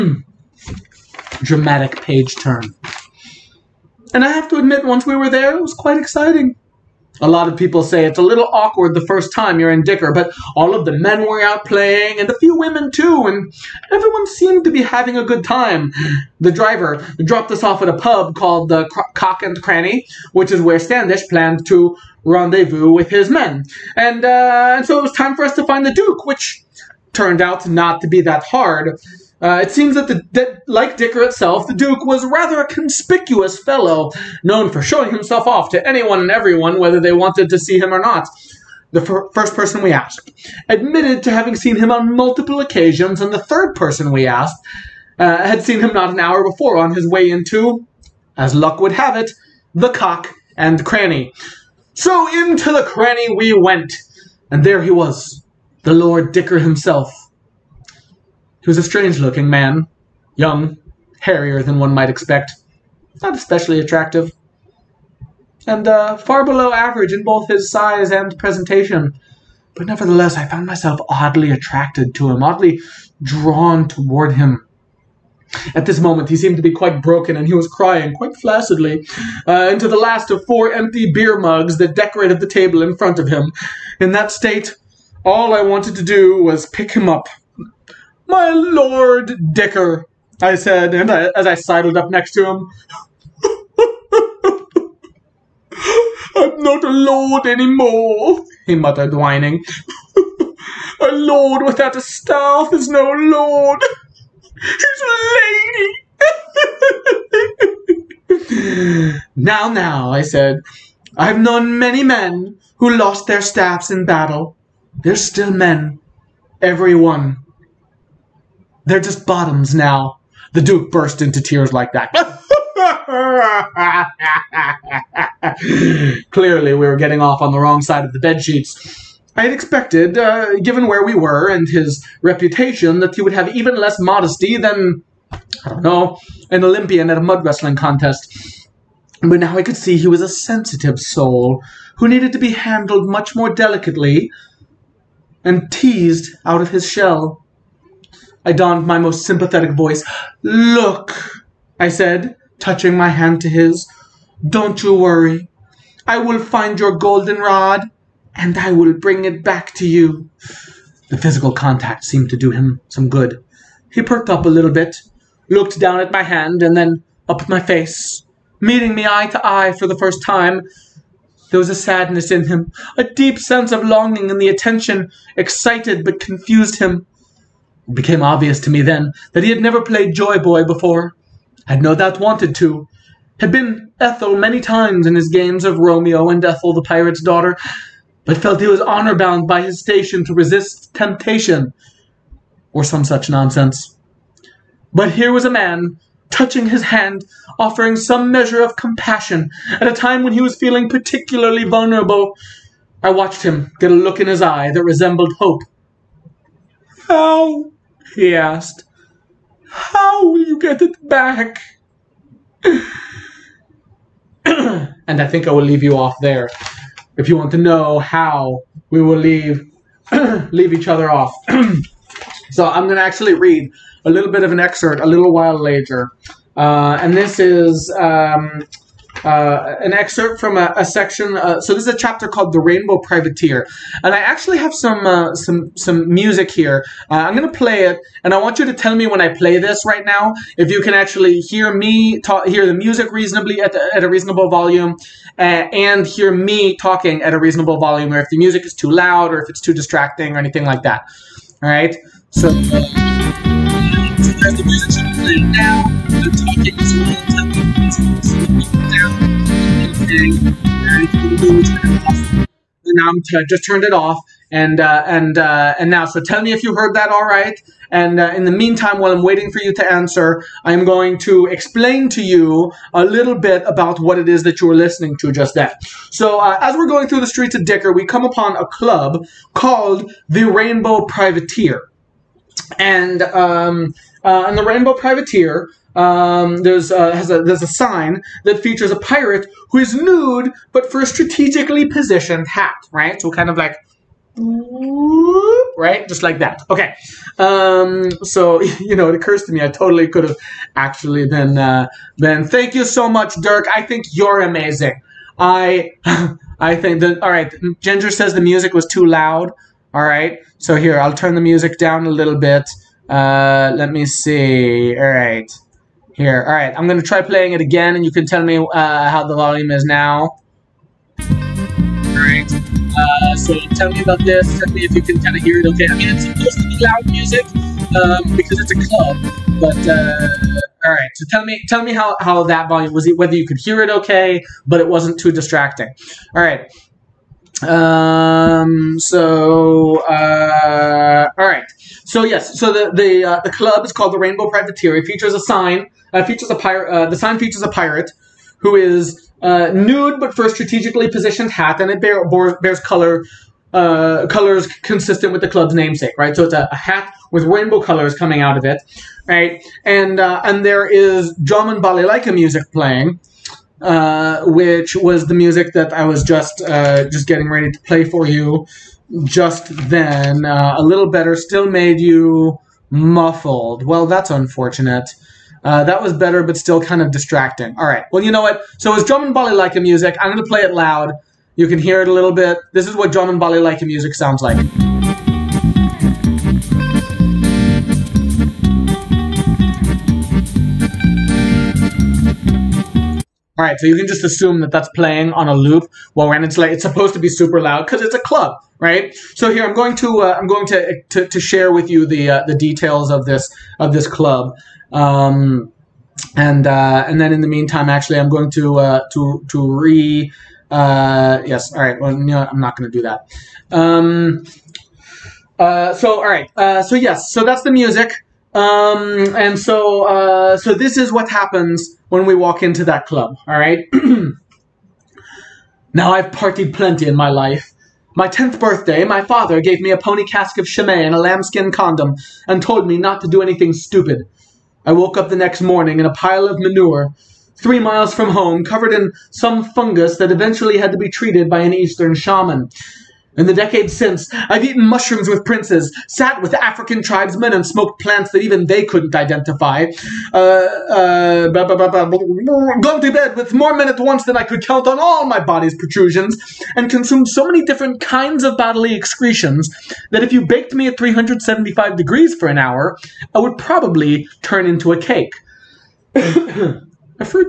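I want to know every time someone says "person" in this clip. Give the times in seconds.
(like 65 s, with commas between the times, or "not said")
39 s, 43 s.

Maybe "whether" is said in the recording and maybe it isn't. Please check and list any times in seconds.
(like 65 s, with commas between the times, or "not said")
36 s, 333 s.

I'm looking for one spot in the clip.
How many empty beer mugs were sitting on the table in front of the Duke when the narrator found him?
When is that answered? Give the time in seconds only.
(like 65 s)
80 s.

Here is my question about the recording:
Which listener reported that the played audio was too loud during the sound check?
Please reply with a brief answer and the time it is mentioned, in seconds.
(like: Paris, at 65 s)
Ginger, at 307 s.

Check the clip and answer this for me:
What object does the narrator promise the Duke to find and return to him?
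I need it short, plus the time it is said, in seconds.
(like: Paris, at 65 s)
golden rod, at 156 s.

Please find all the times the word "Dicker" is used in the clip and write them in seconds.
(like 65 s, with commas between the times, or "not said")
9 s, 30 s, 56 s, 89 s, 277 s.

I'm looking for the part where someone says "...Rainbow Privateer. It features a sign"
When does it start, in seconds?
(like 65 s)
344 s.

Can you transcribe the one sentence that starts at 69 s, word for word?
But nevertheless, I found myself oddly attracted to him, oddly drawn toward him.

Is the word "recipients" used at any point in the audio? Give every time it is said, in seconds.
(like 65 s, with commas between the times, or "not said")
not said.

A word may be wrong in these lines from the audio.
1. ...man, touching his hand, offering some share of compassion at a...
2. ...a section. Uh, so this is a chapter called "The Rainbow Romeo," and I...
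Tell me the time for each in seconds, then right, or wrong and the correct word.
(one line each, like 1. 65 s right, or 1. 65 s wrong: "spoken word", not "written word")
1. 195 s wrong: "measure", not "share"
2. 230 s wrong: "Privateer", not "Romeo".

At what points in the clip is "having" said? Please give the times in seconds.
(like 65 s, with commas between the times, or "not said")
14 s, 41 s.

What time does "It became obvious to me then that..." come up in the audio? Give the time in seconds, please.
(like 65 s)
177 s.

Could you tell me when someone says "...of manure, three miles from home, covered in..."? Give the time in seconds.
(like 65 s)
436 s.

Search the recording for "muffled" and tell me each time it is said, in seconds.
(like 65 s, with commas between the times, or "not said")
372 s.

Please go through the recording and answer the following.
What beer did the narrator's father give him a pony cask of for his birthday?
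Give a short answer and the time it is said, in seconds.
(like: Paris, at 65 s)
Chimay, at 430 s.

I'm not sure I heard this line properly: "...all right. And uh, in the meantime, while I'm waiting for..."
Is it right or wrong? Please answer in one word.
right.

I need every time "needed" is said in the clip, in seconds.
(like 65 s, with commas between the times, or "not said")
142 s.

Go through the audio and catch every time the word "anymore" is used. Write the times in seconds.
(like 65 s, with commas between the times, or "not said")
97 s.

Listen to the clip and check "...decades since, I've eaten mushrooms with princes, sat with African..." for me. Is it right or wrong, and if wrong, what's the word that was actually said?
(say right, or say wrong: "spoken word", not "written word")
right.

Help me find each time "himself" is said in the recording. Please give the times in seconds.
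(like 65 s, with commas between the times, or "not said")
35 s, 56 s.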